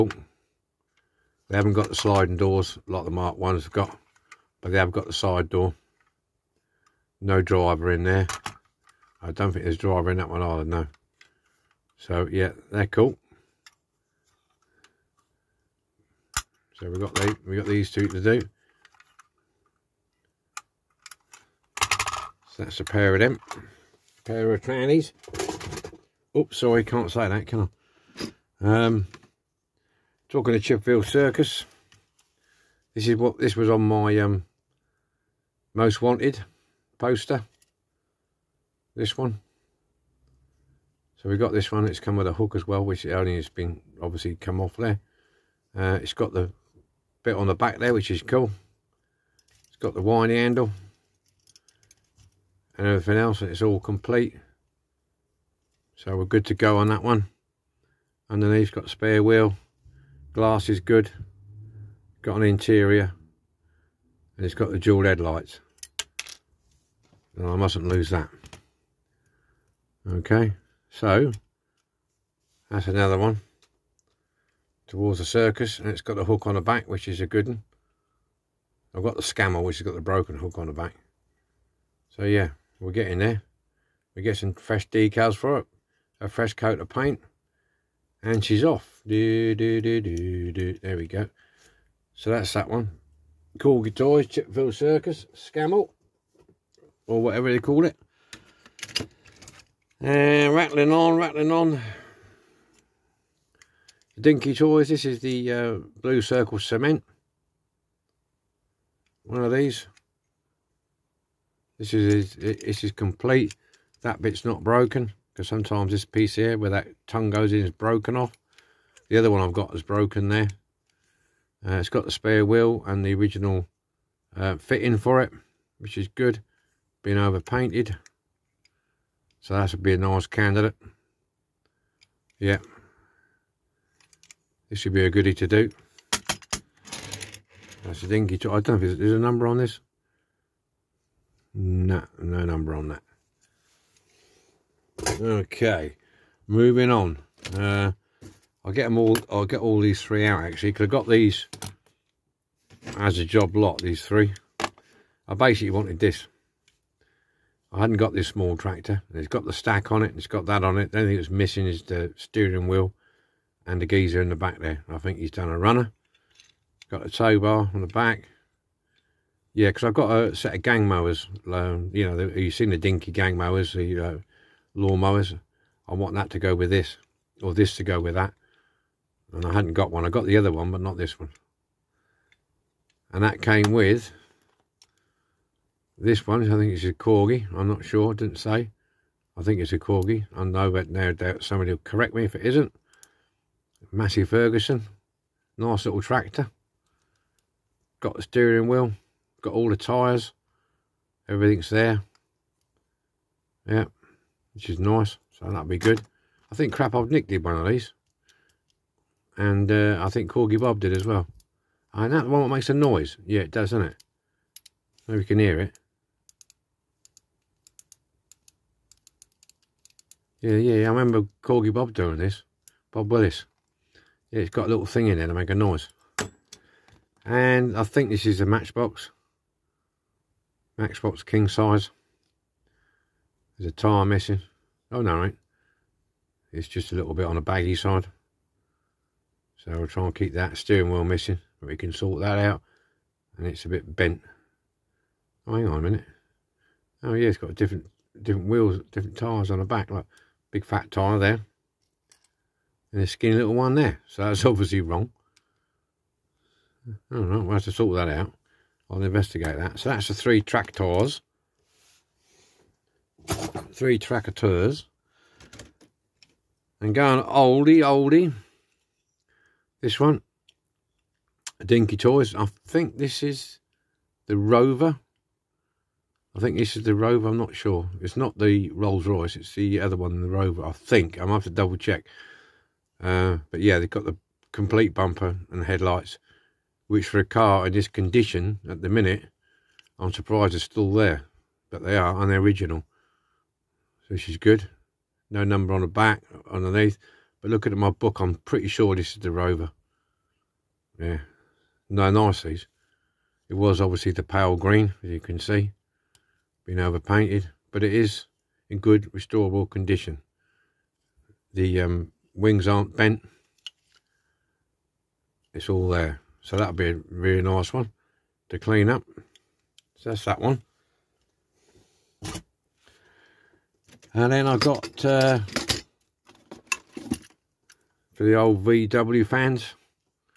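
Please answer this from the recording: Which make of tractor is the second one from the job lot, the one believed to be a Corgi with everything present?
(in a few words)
Massey Ferguson.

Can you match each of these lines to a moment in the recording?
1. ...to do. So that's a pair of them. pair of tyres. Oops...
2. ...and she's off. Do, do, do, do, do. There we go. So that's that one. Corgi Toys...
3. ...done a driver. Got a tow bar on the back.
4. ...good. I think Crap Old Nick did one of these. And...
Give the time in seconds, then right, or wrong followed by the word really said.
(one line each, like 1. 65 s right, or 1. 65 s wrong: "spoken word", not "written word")
1. 18 s wrong: "trannies", not "tyres"
2. 88 s right
3. 165 s wrong: "runner", not "driver"
4. 205 s right.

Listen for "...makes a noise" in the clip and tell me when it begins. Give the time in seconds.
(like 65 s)
212 s.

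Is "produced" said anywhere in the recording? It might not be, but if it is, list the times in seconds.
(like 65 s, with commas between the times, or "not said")
not said.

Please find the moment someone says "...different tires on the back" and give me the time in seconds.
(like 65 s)
248 s.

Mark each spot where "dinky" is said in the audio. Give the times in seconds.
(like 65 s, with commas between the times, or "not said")
104 s, 138 s, 172 s, 271 s.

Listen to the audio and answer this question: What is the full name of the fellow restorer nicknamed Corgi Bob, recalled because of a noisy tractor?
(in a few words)
Bob Willis.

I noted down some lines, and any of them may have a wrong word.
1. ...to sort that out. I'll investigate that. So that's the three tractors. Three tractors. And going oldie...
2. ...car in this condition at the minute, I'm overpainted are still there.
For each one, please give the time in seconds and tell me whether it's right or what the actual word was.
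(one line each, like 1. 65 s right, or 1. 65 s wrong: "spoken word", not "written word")
1. 257 s right
2. 287 s wrong: "surprised", not "overpainted".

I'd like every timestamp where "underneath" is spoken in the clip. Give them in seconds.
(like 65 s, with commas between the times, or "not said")
58 s, 296 s.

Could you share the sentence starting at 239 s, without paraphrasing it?
So we will try and keep that steering wheel missing.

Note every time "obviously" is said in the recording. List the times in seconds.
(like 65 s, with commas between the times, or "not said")
44 s, 254 s, 303 s.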